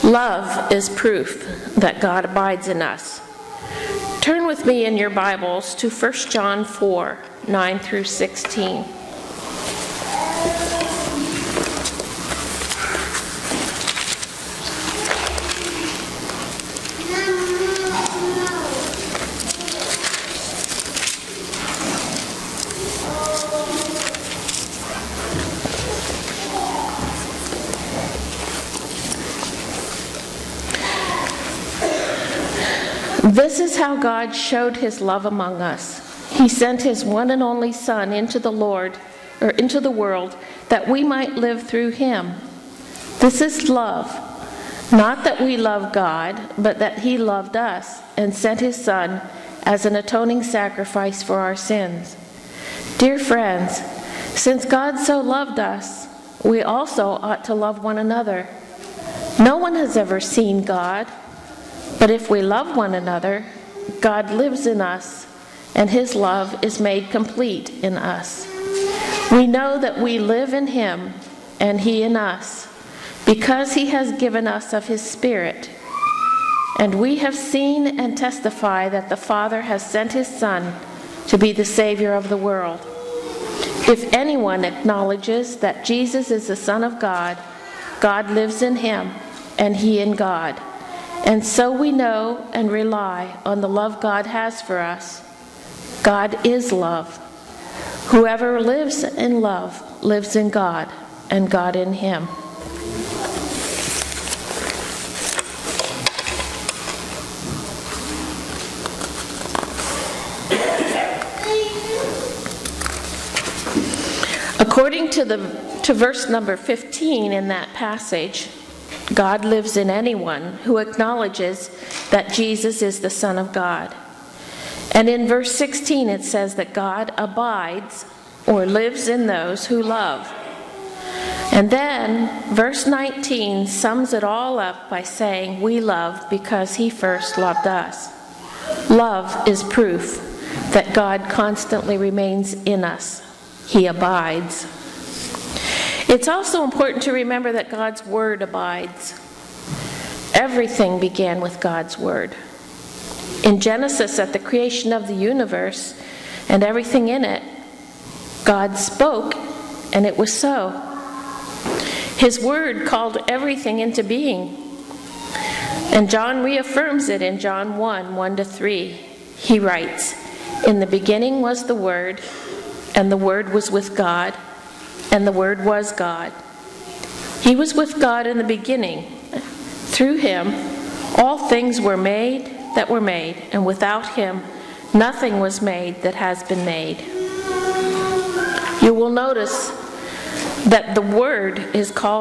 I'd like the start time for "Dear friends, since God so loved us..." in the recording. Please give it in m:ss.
0:52.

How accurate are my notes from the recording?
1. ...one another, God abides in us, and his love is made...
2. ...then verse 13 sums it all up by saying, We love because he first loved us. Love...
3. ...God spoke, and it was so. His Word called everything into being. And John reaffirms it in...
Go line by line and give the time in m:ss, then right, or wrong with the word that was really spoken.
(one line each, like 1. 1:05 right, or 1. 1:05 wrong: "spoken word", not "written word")
1. 1:02 wrong: "lives", not "abides"
2. 2:11 wrong: "19", not "13"
3. 2:38 right.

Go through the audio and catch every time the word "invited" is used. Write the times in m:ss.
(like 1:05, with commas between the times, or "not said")
not said.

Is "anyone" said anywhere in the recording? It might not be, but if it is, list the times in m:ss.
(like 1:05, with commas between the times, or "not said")
1:24, 1:59.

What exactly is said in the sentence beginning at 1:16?
And we have seen and testify that the Father has sent his Son to be the Savior of the world.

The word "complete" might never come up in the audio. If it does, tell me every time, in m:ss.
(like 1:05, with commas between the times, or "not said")
1:07.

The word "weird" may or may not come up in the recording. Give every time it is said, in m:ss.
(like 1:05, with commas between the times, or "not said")
not said.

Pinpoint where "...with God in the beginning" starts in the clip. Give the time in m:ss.
2:57.